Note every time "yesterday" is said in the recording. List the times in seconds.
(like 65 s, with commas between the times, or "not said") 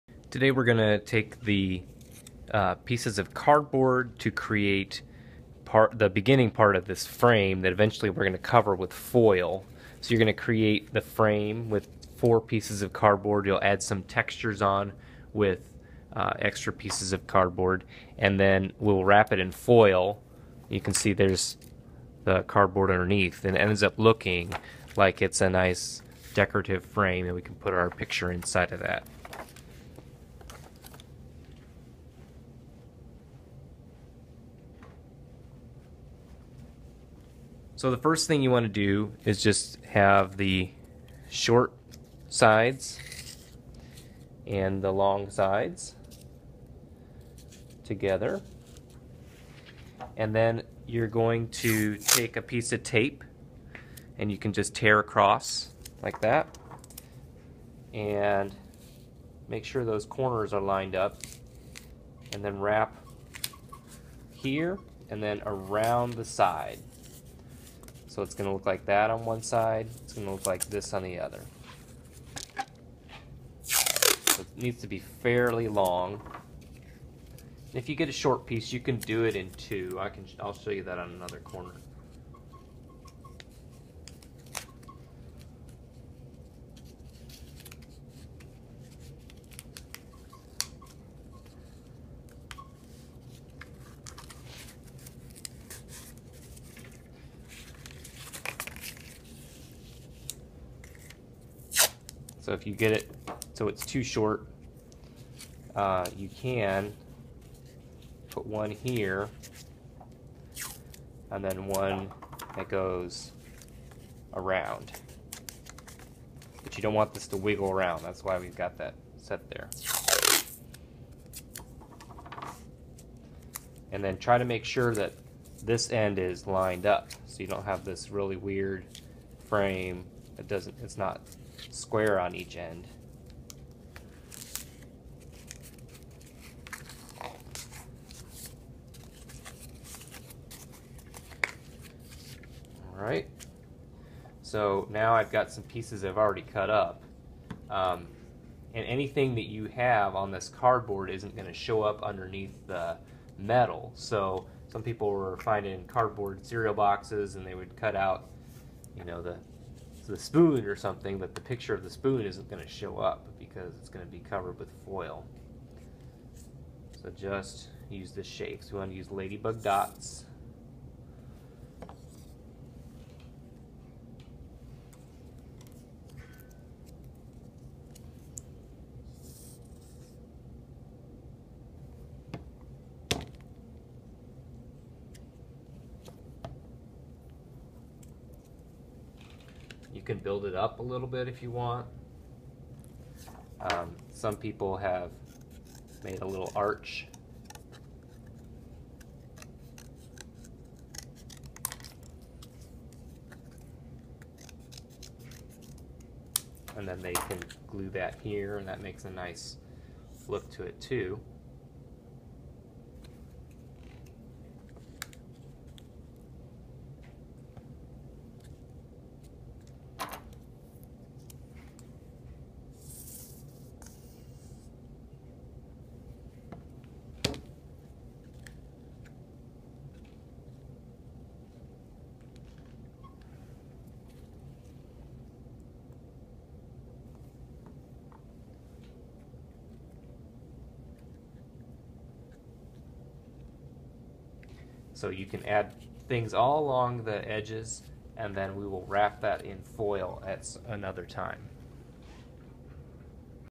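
not said.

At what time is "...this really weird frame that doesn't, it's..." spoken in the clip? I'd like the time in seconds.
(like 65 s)
127 s.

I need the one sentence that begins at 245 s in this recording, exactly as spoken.
So you can add things all along the edges and then we will wrap that in foil at another time.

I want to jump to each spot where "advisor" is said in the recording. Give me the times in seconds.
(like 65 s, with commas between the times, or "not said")
not said.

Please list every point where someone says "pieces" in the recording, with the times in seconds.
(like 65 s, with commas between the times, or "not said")
2 s, 12 s, 16 s, 52 s, 78 s, 145 s.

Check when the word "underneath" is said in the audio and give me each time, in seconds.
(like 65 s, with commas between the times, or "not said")
22 s, 152 s.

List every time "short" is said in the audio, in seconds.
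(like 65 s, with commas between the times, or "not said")
41 s, 78 s, 104 s.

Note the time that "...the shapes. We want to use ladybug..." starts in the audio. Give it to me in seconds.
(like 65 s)
168 s.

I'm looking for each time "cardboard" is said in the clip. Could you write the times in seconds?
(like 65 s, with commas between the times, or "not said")
3 s, 12 s, 17 s, 22 s, 150 s, 155 s.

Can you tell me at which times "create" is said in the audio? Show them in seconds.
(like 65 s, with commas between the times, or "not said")
4 s, 10 s.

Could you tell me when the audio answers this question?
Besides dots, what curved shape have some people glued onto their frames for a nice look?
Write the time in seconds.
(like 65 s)
196 s.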